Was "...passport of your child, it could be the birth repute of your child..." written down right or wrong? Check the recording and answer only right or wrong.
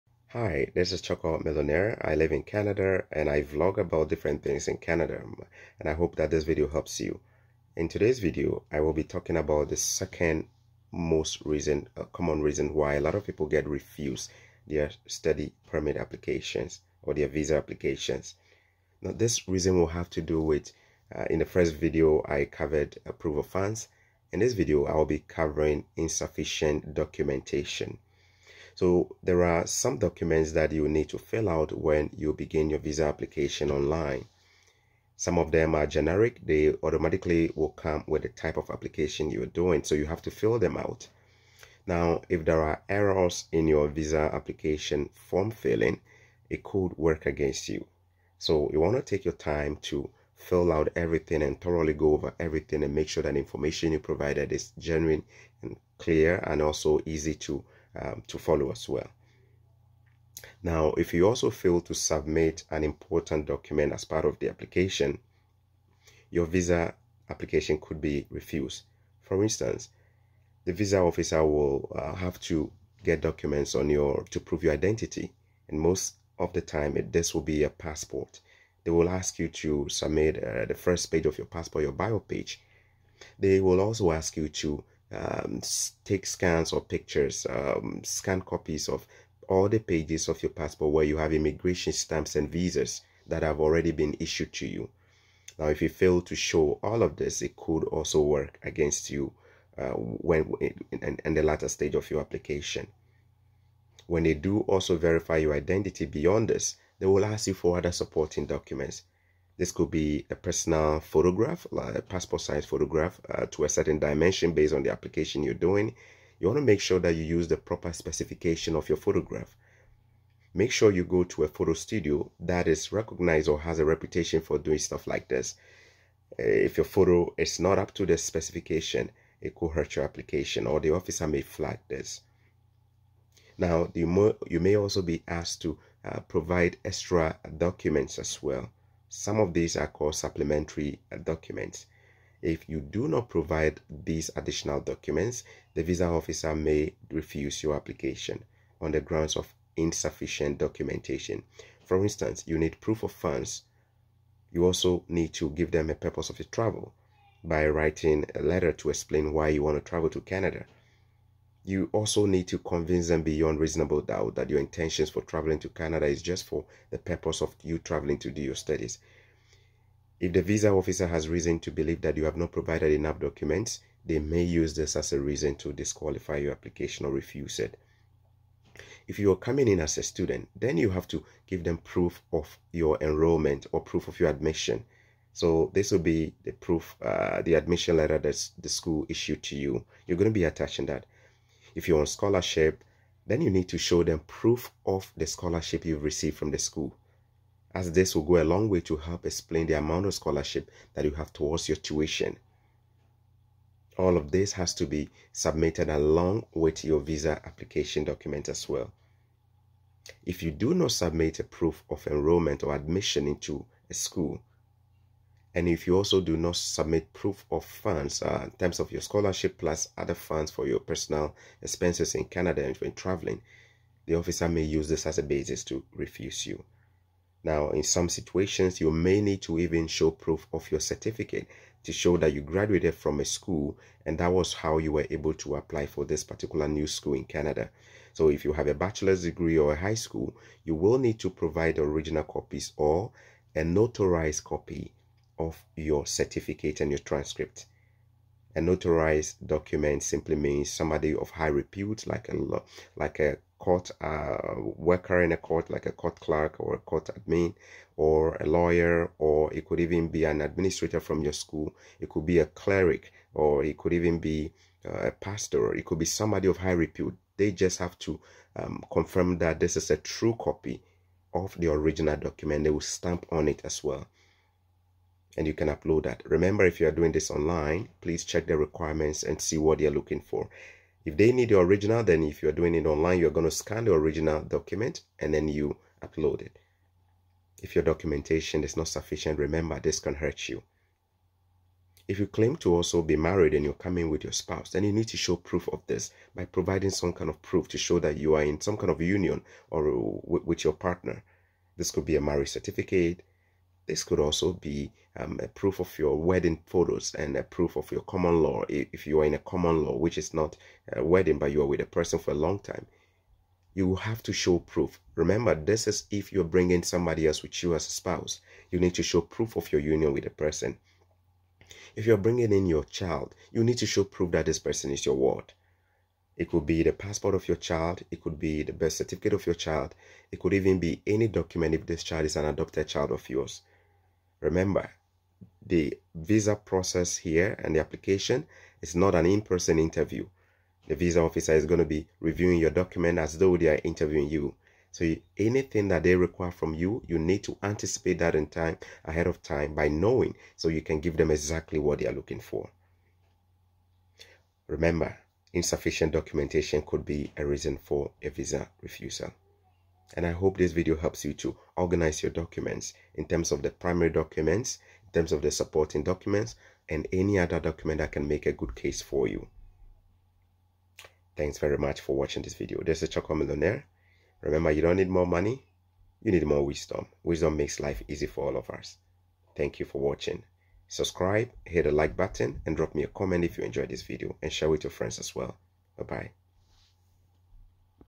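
wrong.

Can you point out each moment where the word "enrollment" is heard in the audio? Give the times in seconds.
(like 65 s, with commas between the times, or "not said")
183 s, 212 s.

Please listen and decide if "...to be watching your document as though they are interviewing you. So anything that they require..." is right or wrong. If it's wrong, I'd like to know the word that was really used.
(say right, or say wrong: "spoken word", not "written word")
wrong: "reviewing", not "watching".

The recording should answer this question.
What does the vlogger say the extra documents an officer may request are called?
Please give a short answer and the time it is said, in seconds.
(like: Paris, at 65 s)
Supplementary documents, at 140 s.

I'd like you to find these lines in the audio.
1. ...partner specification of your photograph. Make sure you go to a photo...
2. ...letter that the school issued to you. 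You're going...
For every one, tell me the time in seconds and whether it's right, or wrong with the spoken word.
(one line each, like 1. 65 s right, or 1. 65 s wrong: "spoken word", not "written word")
1. 117 s wrong: "proper", not "partner"
2. 187 s right.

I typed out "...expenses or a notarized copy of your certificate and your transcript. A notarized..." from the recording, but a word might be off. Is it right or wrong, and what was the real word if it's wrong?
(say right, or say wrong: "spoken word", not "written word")
wrong: "copies", not "expenses".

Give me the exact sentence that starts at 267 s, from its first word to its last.
They just have to um, confirm that this is a true copy of the original document.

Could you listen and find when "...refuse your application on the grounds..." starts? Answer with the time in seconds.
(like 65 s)
147 s.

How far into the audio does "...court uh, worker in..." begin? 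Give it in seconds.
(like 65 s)
253 s.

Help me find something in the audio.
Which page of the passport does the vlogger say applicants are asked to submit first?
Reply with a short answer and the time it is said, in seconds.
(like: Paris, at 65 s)
Bio page, at 81 s.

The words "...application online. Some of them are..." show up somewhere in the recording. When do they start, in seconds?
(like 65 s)
33 s.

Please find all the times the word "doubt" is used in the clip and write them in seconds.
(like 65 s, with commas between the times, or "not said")
164 s.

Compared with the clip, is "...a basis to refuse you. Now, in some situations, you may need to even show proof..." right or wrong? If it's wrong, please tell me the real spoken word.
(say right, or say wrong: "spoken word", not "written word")
right.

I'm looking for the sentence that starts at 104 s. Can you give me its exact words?
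When they do also verify your identity beyond this, they will ask you for other supporting documents.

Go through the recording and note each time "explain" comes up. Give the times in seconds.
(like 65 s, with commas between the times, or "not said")
158 s, 199 s.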